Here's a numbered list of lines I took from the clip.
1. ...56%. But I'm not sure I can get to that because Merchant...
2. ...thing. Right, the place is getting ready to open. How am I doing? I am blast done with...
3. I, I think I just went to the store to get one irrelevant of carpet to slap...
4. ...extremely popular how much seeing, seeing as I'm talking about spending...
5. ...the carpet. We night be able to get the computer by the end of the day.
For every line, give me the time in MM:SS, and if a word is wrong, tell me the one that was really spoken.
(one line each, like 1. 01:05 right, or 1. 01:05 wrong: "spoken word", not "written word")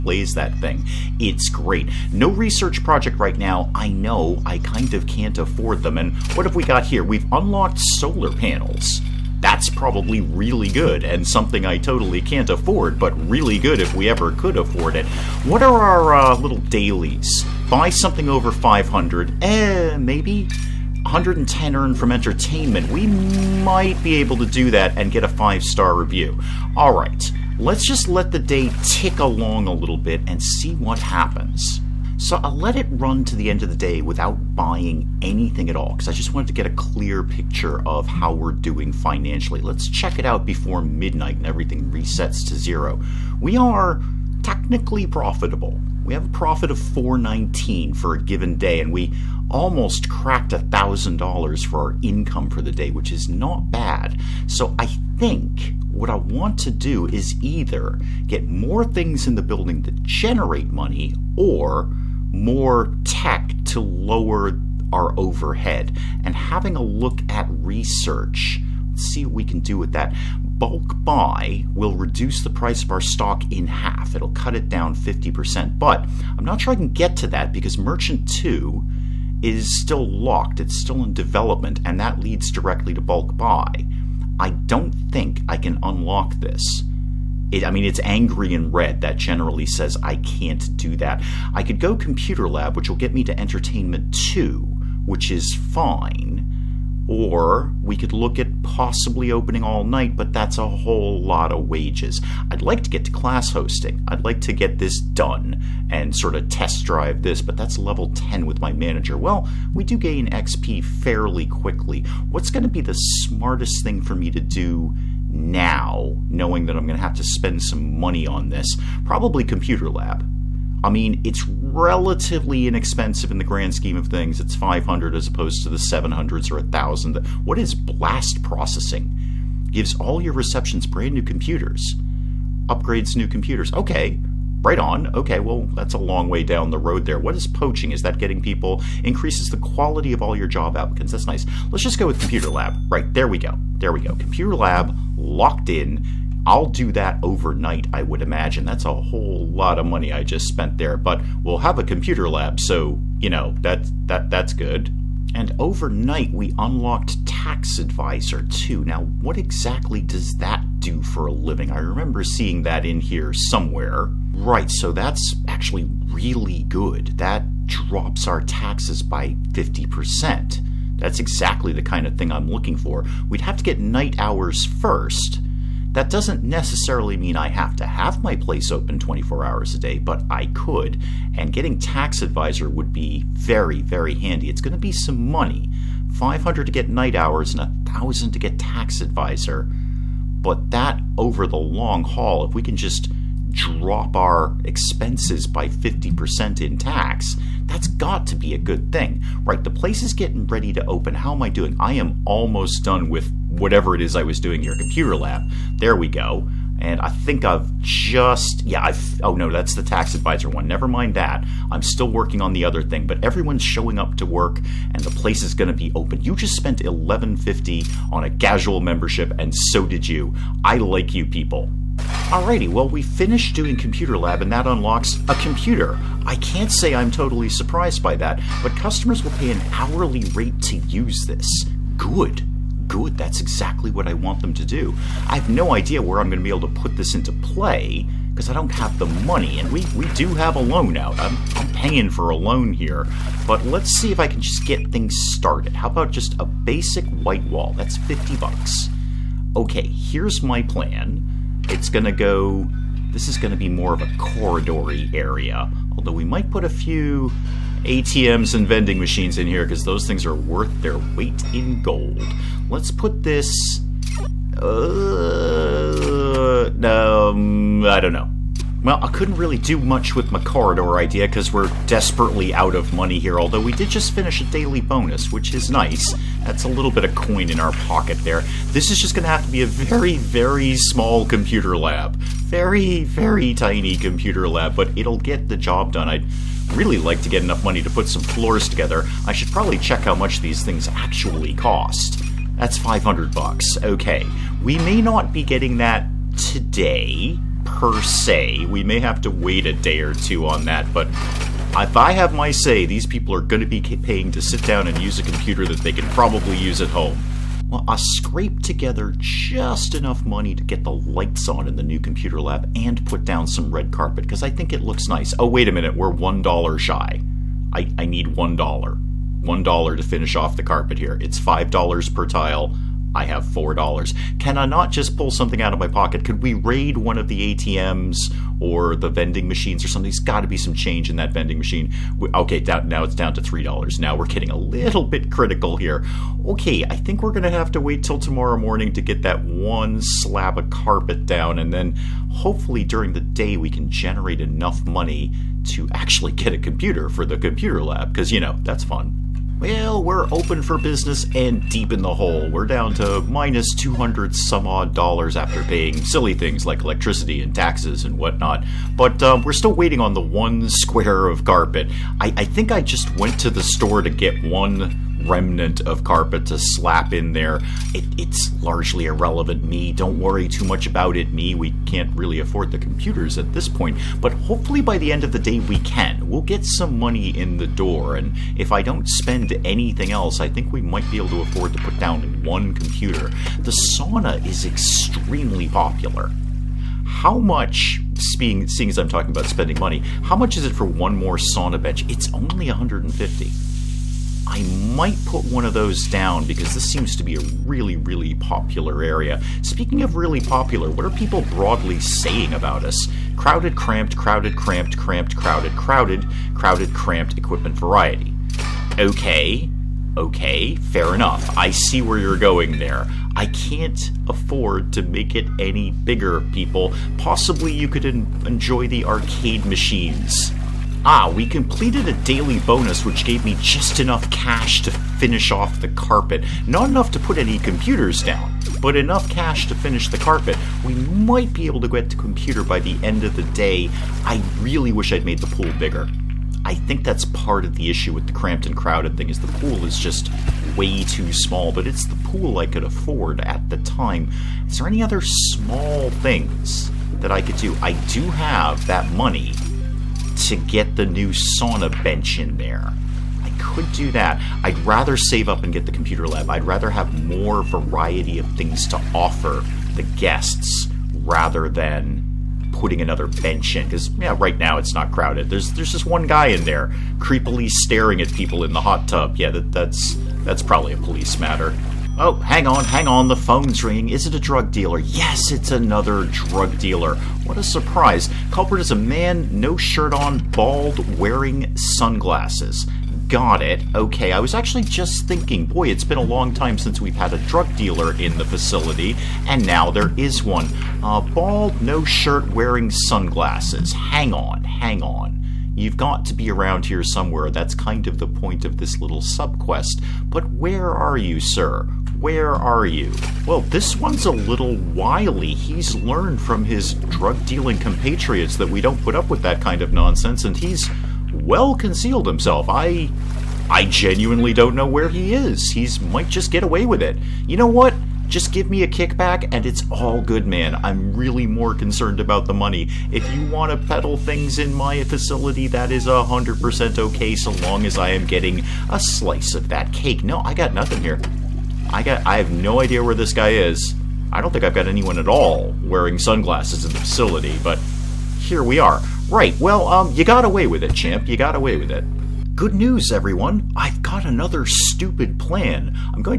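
1. 01:14 wrong: "50", not "56"
2. 03:18 wrong: "almost", not "blast"
3. 06:02 wrong: "remnant", not "irrelevant"
4. 06:24 right
5. 07:10 wrong: "might", not "night".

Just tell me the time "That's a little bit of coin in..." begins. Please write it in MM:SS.
04:36.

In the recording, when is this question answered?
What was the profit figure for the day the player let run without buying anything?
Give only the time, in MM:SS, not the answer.
00:46.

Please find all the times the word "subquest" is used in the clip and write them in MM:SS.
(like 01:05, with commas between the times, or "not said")
08:19.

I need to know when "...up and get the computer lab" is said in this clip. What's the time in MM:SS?
07:35.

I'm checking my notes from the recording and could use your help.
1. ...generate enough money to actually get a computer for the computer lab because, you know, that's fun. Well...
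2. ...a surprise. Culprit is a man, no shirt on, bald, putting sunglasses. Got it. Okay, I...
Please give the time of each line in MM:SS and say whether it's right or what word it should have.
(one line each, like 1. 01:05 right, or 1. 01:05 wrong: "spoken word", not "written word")
1. 05:43 right
2. 07:57 wrong: "wearing", not "putting".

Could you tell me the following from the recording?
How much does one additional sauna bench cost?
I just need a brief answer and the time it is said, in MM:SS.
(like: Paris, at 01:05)
150, at 06:32.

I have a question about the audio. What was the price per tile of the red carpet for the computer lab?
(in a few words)
$5.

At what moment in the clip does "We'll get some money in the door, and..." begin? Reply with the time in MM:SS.
06:16.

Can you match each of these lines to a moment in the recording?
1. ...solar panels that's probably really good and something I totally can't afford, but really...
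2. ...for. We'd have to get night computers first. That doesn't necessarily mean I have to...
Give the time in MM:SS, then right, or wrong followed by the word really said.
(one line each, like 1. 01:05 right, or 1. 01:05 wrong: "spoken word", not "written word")
1. 00:07 right
2. 02:52 wrong: "hours", not "computers".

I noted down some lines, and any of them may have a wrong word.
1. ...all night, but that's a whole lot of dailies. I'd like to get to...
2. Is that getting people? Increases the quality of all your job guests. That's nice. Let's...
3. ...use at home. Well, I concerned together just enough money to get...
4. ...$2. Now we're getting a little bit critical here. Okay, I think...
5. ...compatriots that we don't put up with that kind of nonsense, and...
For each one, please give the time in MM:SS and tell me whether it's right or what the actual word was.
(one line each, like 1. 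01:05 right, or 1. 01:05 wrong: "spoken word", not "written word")
1. 01:39 wrong: "wages", not "dailies"
2. 02:17 wrong: "applicants", not "guests"
3. 05:06 wrong: "scraped", not "concerned"
4. 05:33 wrong: "3", not "2"
5. 08:27 right.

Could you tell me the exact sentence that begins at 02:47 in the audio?
That drops our taxes by 50%.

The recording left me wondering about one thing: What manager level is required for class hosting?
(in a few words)
10.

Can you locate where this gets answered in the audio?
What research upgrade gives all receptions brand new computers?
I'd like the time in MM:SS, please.
02:07.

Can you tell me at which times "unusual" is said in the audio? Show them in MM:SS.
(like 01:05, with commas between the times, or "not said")
not said.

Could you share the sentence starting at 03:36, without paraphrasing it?
You just spent 1150 on a casual membership and so did you.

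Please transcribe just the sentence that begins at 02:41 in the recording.
I remember seeing that in here somewhere.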